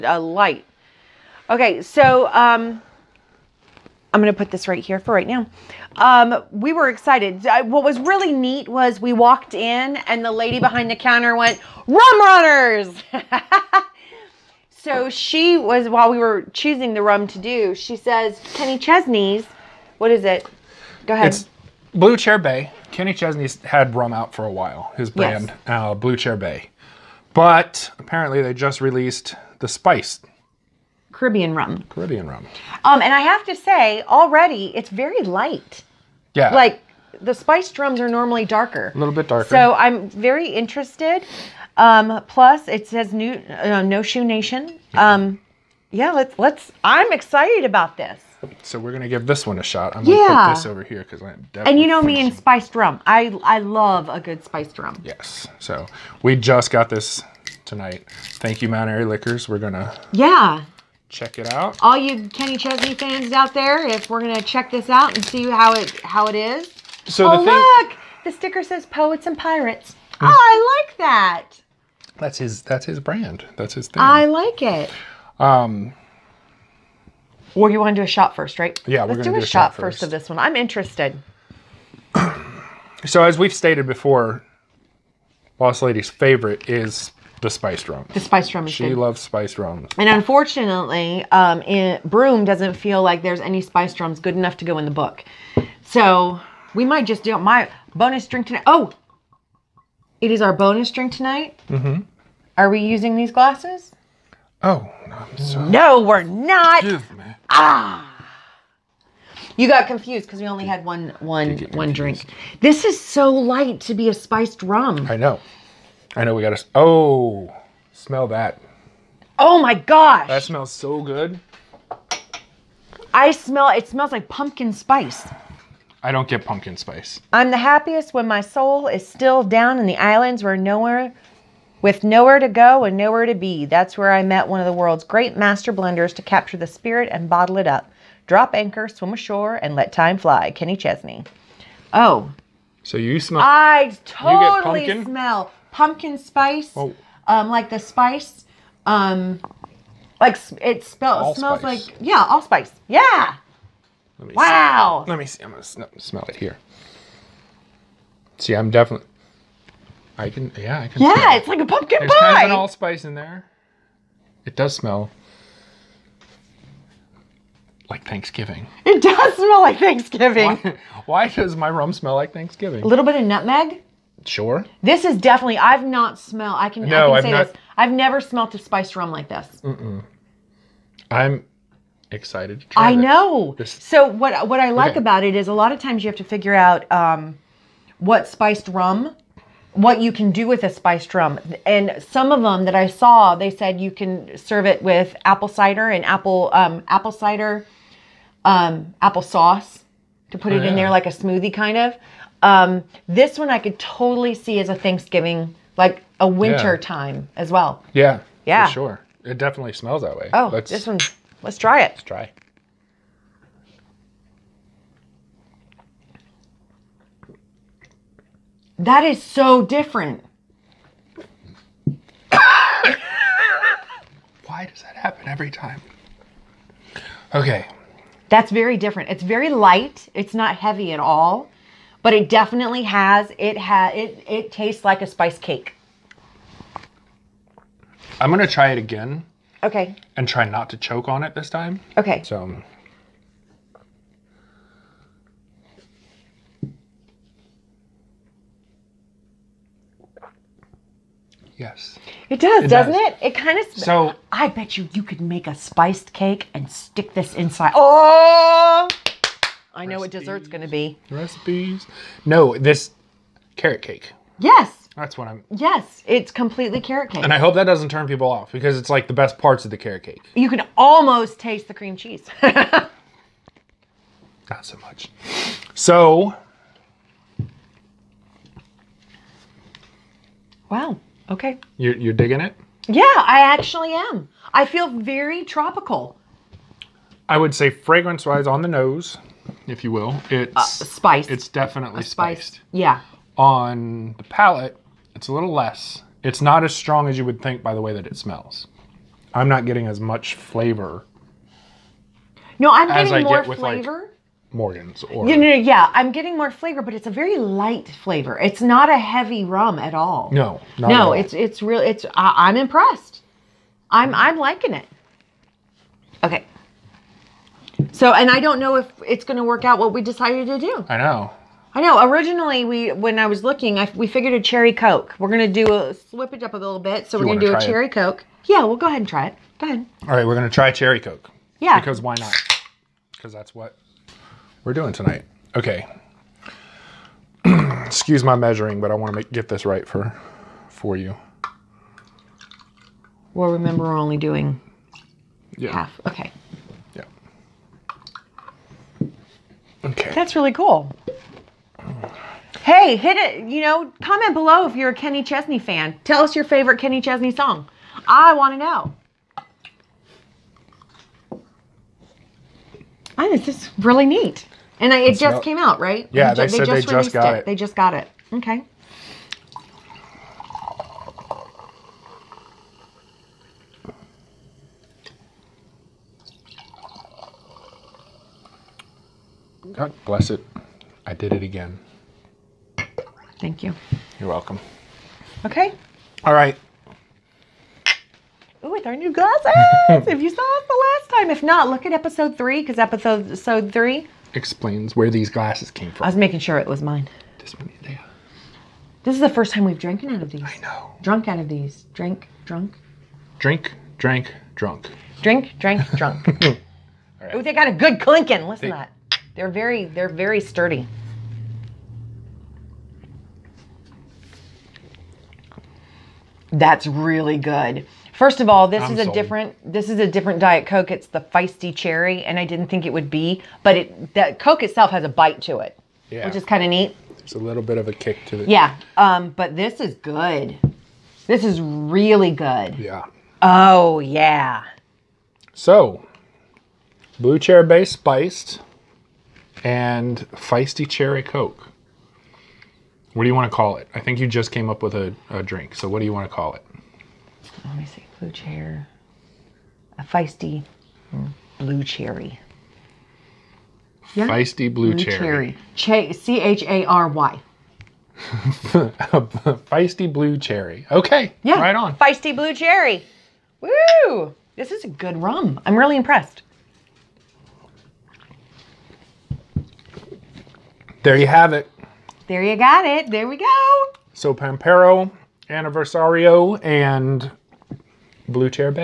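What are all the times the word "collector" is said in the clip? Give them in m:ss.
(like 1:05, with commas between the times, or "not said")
not said.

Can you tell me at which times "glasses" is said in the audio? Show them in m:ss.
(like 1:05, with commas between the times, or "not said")
1:43, 6:29, 6:35.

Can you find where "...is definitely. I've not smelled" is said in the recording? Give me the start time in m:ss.
2:55.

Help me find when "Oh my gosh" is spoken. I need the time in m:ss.
1:59.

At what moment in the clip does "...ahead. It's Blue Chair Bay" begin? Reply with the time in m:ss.
0:21.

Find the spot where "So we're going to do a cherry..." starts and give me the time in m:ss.
5:27.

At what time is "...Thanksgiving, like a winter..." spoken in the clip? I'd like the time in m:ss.
3:24.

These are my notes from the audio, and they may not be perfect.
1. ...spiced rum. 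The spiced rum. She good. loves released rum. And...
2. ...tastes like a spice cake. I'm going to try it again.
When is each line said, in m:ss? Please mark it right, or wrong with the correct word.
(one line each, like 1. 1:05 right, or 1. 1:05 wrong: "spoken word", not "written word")
1. 1:27 wrong: "spiced", not "released"
2. 3:54 right.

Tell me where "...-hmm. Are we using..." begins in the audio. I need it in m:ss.
1:41.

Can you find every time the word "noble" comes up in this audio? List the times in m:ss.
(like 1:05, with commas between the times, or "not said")
not said.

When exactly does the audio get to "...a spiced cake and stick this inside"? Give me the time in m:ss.
4:15.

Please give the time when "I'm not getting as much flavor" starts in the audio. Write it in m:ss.
4:59.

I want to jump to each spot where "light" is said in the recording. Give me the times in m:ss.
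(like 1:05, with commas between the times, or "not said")
0:00, 0:35, 1:53, 3:49, 5:07.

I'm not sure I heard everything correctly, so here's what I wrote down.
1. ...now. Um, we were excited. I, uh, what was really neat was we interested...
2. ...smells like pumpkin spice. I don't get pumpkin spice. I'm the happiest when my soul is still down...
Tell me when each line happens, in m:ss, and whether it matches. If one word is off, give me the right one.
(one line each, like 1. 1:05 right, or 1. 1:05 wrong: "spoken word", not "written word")
1. 0:05 wrong: "walked", not "interested"
2. 2:03 right.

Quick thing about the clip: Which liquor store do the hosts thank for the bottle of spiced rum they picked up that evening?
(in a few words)
Mount Airy Liquors.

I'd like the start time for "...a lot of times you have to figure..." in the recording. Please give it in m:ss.
3:05.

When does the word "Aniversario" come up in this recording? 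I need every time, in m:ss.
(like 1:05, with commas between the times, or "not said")
7:55.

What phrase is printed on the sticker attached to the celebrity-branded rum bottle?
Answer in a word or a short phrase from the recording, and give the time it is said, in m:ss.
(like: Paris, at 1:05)
Poets and pirates, at 1:08.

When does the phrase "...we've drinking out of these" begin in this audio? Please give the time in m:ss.
6:39.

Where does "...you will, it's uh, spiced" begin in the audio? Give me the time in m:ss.
4:49.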